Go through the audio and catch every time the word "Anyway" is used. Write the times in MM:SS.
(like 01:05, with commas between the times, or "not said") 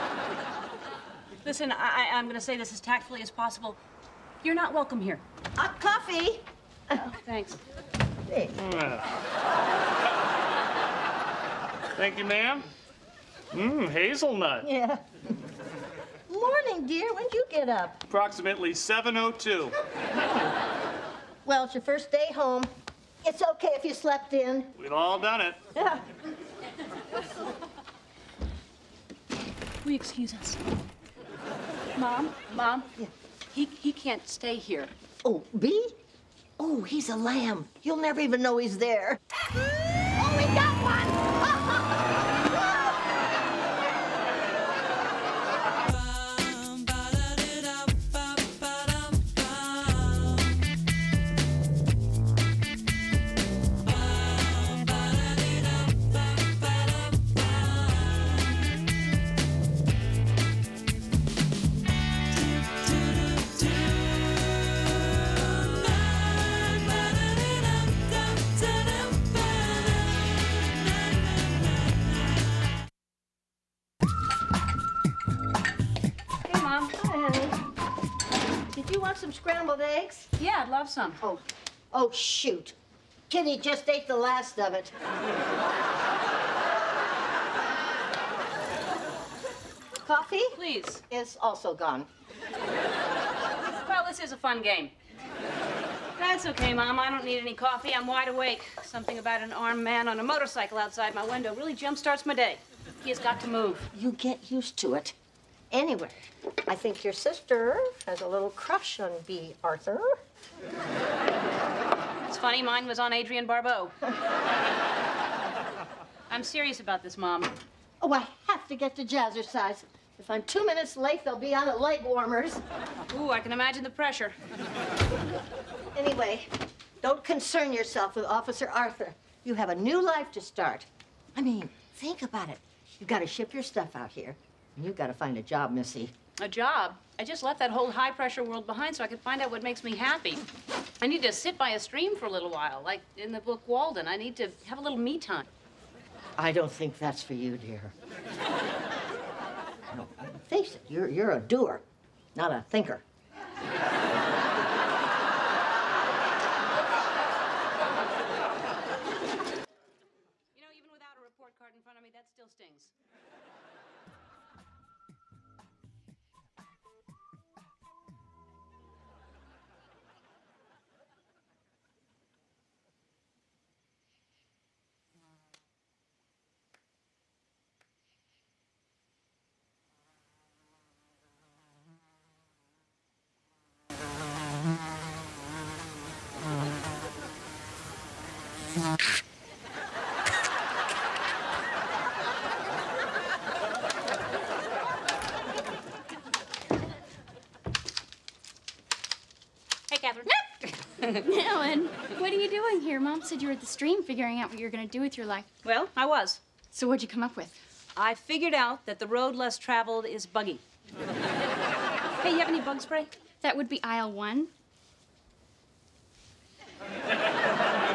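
01:45, 02:05.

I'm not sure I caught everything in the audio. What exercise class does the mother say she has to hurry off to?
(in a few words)
Jazzercise.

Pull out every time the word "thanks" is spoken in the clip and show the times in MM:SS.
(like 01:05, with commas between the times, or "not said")
00:07, 00:11.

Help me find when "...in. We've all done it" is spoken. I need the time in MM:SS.
00:24.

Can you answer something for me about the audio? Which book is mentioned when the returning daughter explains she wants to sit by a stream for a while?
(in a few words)
Walden.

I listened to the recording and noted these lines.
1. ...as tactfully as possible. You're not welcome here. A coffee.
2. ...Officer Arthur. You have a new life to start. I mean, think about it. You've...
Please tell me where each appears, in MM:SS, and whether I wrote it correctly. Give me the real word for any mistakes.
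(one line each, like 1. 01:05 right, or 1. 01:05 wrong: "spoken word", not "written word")
1. 00:02 right
2. 02:08 right.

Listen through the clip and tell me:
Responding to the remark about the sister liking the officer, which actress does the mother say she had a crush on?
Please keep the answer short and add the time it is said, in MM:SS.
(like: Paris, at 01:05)
Adrienne Barbeau, at 01:53.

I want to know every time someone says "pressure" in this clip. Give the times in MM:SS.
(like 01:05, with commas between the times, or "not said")
02:03, 02:18.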